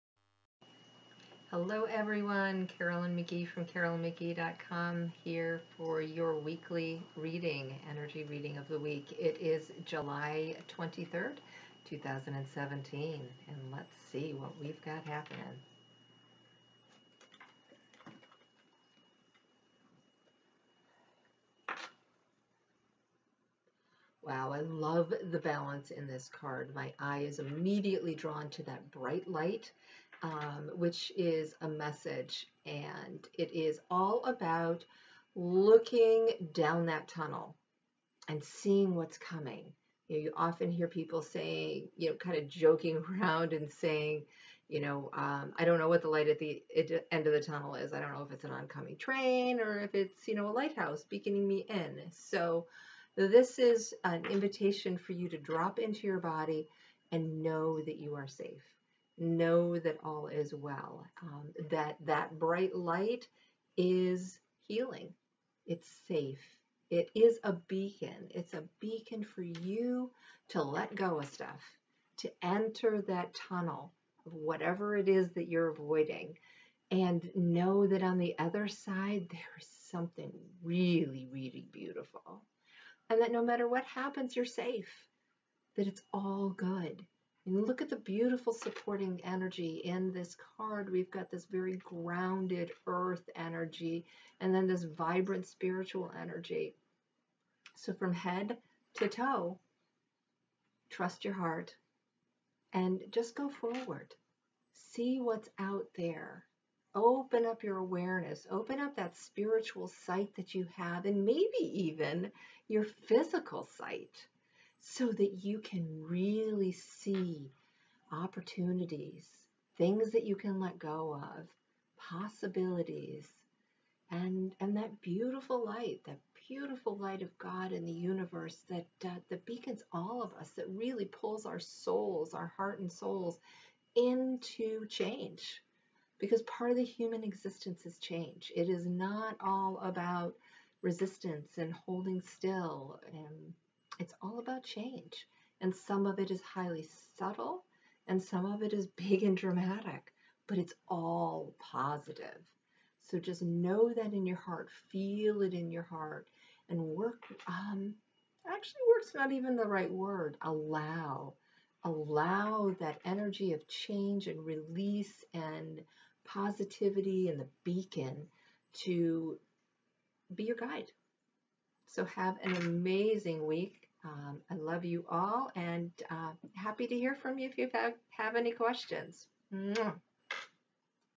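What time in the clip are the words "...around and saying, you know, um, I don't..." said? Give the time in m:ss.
0:43.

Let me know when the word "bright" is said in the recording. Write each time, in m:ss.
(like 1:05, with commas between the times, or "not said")
0:28, 1:02.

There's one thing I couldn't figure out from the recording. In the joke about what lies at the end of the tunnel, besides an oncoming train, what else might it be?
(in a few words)
a lighthouse.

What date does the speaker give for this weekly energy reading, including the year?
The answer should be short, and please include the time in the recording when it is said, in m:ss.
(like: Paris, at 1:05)
July 23rd, 2017, at 0:09.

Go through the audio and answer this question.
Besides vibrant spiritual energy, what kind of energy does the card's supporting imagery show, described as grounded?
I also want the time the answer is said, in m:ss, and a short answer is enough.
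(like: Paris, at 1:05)
earth energy, at 1:32.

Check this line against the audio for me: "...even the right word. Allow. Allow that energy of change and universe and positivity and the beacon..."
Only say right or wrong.
wrong.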